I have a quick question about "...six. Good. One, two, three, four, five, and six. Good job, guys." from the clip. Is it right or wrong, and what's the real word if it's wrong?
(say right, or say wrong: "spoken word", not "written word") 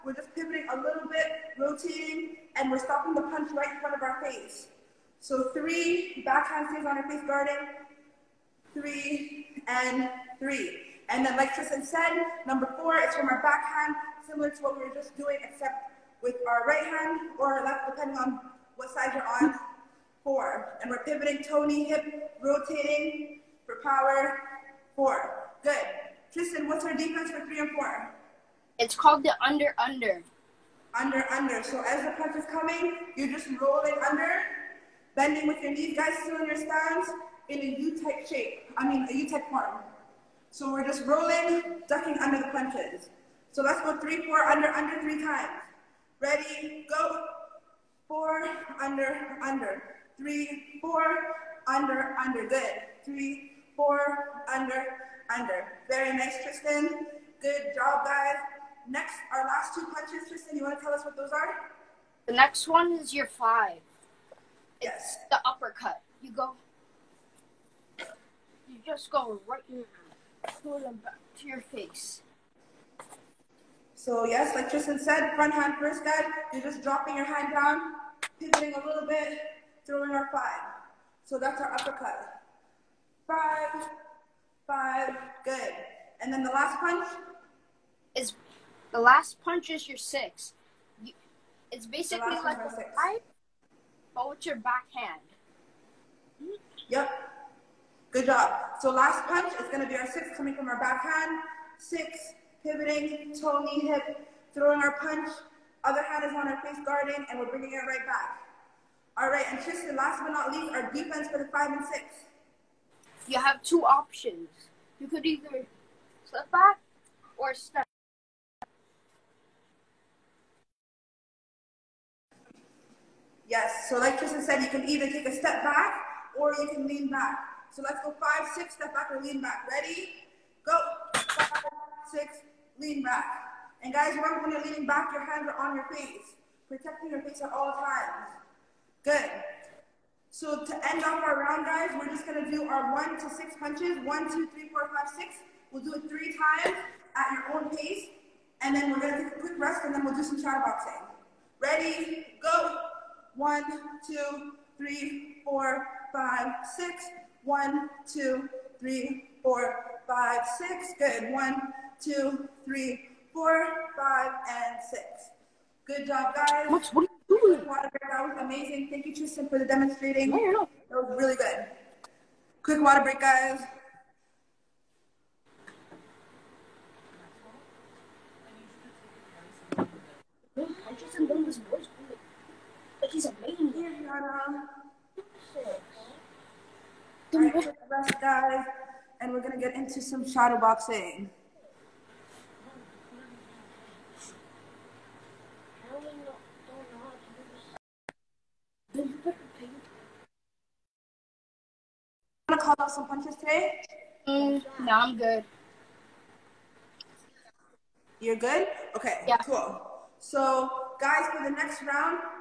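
right.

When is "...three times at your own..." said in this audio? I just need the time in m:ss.
2:26.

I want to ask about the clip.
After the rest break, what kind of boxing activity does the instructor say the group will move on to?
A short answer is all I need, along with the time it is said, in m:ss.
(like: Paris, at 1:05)
Shadow boxing, at 3:10.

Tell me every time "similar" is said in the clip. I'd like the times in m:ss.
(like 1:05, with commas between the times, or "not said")
0:14.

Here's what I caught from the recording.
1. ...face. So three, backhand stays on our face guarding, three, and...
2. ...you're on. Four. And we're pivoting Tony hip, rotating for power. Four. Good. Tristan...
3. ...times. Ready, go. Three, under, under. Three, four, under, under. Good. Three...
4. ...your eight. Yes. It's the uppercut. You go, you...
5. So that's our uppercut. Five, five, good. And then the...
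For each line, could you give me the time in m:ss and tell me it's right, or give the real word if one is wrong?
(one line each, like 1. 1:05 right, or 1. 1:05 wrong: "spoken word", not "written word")
1. 0:04 right
2. 0:19 right
3. 0:45 wrong: "Four", not "Three"
4. 1:03 wrong: "five", not "eight"
5. 1:21 right.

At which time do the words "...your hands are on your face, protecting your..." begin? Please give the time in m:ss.
2:15.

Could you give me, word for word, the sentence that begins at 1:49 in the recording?
All right, and Tristan, last but not least, our defense for the five and six.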